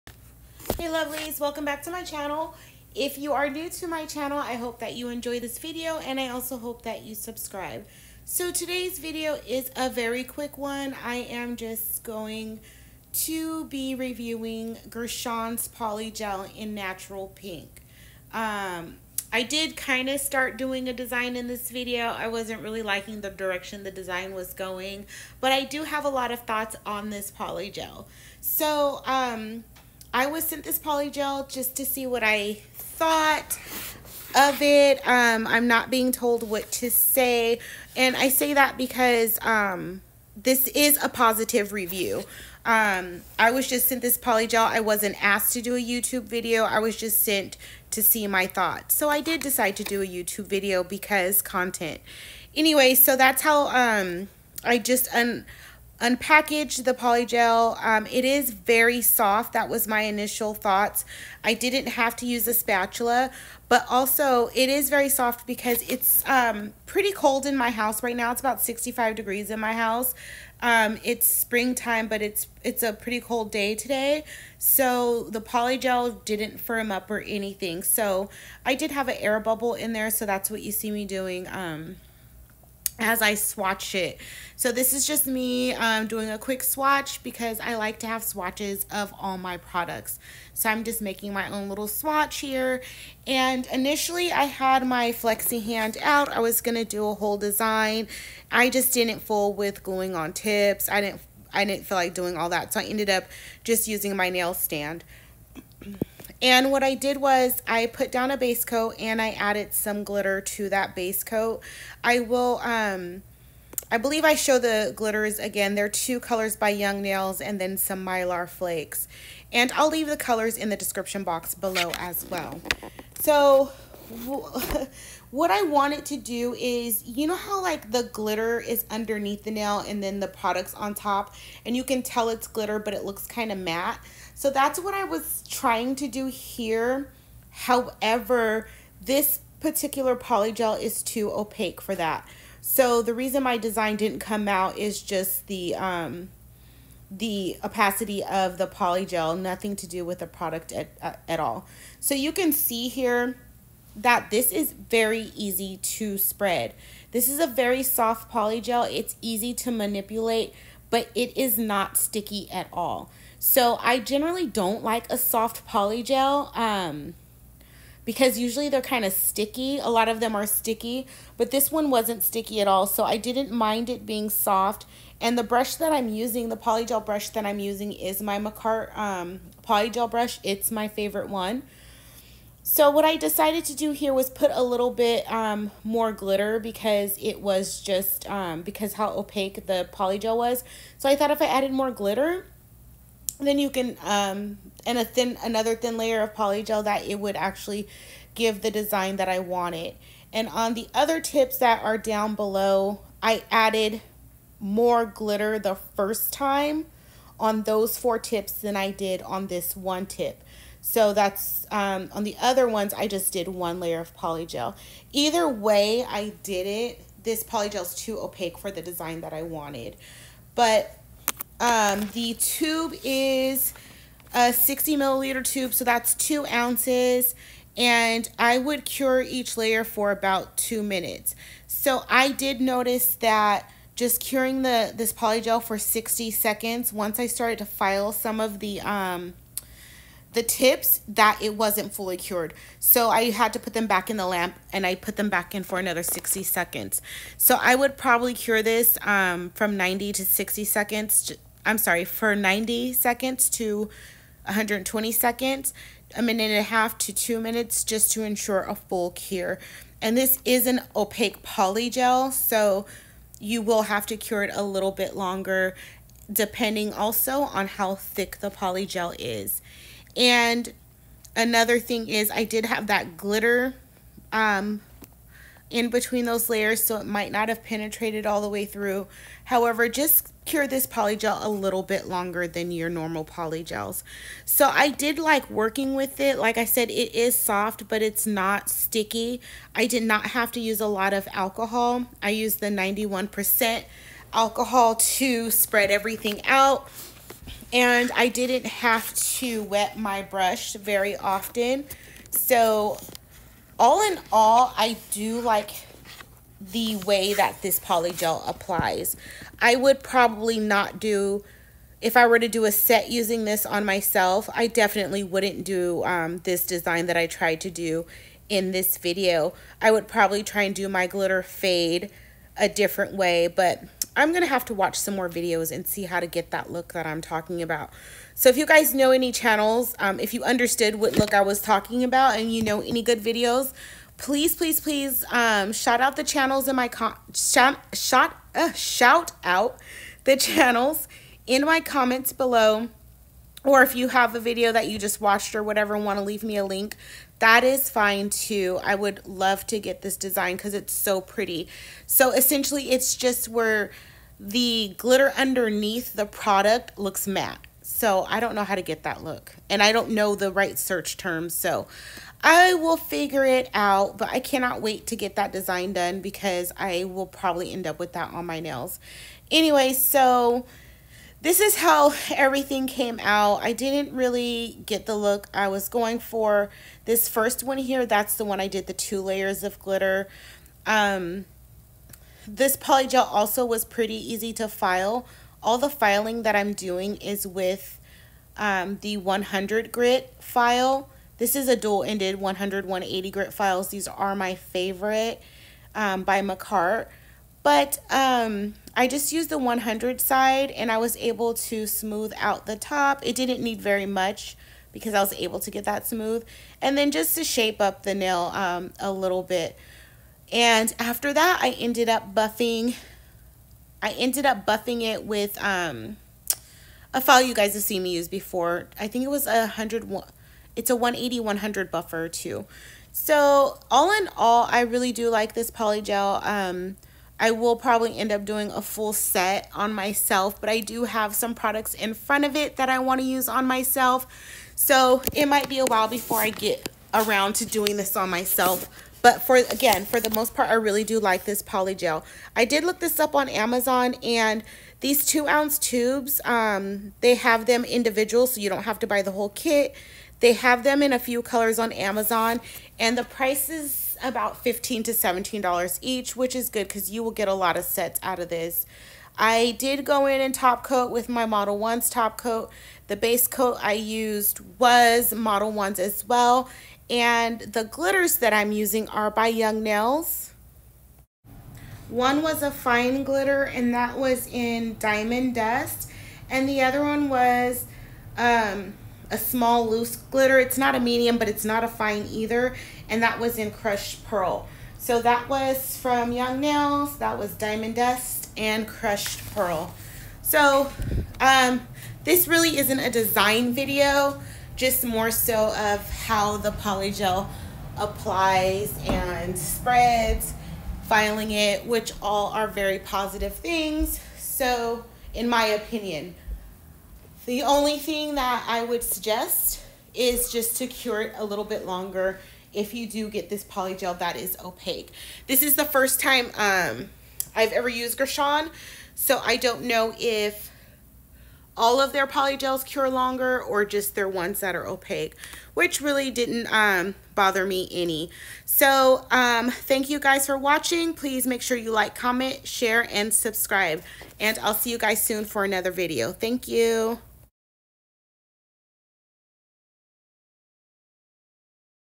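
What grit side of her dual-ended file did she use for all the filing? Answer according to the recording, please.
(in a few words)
100.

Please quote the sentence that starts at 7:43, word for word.
The base coat I used was Modelones as well.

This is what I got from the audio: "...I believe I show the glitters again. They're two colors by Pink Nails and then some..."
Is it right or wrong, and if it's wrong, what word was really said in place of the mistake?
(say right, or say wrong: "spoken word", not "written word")
wrong: "Young", not "Pink".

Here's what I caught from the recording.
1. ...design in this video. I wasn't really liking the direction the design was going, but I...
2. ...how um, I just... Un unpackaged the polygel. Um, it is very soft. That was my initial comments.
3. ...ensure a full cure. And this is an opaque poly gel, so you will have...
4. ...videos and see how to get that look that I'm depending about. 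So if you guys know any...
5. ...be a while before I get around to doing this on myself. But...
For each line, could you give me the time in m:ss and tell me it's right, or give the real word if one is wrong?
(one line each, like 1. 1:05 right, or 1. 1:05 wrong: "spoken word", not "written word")
1. 0:20 right
2. 0:53 wrong: "thoughts", not "comments"
3. 4:18 right
4. 5:25 wrong: "talking", not "depending"
5. 7:15 right.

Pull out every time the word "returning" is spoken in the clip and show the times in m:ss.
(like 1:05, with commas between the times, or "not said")
not said.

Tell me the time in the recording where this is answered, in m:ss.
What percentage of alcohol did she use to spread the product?
4:52.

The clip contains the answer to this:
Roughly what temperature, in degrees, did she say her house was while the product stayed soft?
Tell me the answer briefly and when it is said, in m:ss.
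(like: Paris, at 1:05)
65, at 1:08.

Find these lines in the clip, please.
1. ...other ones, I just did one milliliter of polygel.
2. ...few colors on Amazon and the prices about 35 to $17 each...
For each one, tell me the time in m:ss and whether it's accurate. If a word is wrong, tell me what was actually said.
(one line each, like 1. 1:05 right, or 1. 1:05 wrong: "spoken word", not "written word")
1. 3:32 wrong: "layer", not "milliliter"
2. 7:31 wrong: "15", not "35".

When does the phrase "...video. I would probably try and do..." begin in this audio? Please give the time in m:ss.
5:18.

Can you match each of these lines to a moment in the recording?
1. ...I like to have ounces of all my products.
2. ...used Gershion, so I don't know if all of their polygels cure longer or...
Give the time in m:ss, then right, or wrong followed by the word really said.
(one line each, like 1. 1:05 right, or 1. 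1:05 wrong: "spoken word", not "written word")
1. 1:27 wrong: "swatches", not "ounces"
2. 8:37 right.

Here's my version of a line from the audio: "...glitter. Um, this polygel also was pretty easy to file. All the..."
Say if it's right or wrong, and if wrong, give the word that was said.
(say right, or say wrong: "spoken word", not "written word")
right.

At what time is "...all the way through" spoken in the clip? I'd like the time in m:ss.
4:38.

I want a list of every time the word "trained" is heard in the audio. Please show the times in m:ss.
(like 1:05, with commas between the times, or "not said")
not said.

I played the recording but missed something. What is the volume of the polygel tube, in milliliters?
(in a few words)
60.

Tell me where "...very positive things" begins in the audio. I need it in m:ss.
8:22.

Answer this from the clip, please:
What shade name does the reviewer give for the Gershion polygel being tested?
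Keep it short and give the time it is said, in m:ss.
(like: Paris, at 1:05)
Natural Pink, at 0:16.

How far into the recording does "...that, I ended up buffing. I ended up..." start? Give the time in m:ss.
6:51.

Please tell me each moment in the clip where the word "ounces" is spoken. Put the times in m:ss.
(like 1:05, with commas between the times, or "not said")
3:46, 7:25.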